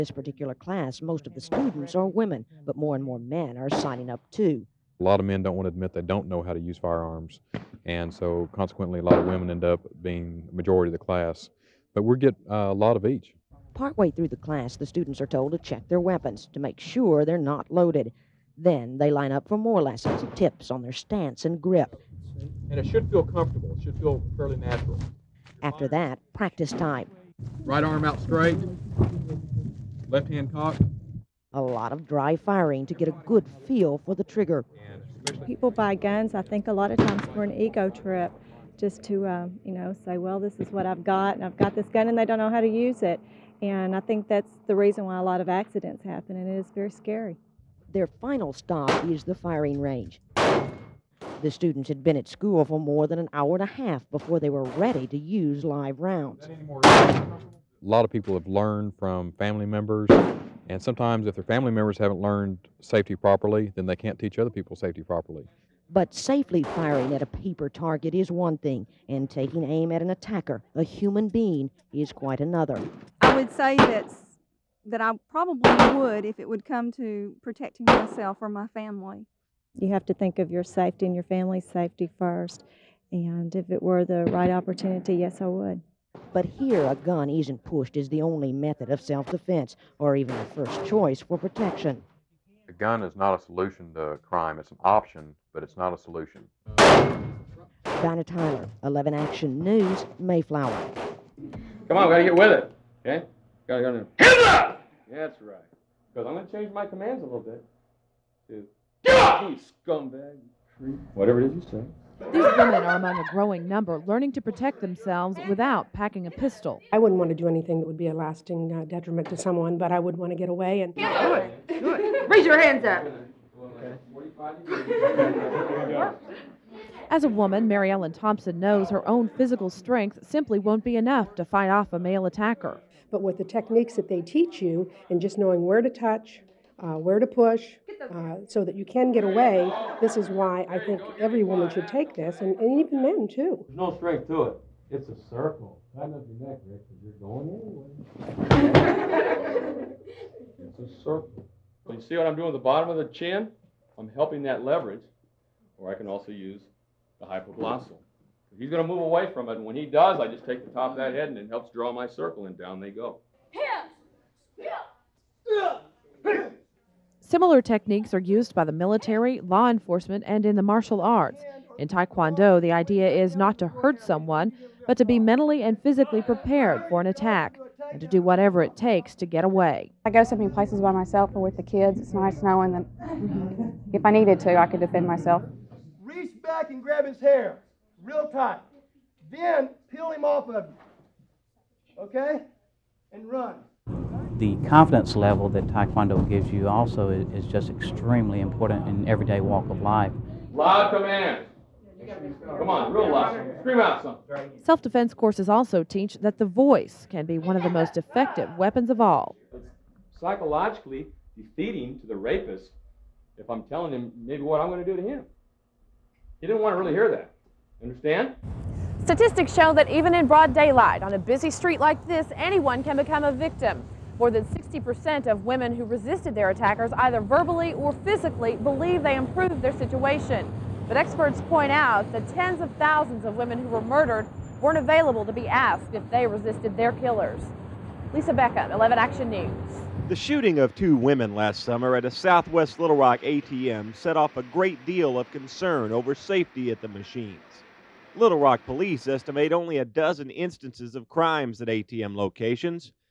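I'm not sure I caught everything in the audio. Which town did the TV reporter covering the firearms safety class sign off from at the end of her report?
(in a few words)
Mayflower.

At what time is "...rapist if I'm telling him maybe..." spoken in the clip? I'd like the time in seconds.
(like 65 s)
212 s.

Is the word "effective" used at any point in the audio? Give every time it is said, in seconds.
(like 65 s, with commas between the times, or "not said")
207 s.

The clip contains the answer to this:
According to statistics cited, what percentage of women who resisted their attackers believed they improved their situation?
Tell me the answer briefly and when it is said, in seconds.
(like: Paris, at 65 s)
60%, at 224 s.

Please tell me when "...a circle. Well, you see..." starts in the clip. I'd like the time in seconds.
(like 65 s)
150 s.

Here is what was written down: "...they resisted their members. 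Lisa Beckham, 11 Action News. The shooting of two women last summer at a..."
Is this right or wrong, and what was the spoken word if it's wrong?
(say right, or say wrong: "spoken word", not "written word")
wrong: "killers", not "members".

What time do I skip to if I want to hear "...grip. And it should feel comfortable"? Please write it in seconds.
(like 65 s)
21 s.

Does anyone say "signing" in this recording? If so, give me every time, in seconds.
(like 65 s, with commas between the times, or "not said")
3 s.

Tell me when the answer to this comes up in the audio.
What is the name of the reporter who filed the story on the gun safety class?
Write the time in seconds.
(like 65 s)
96 s.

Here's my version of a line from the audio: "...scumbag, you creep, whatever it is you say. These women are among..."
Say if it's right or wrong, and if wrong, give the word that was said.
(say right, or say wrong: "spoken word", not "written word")
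right.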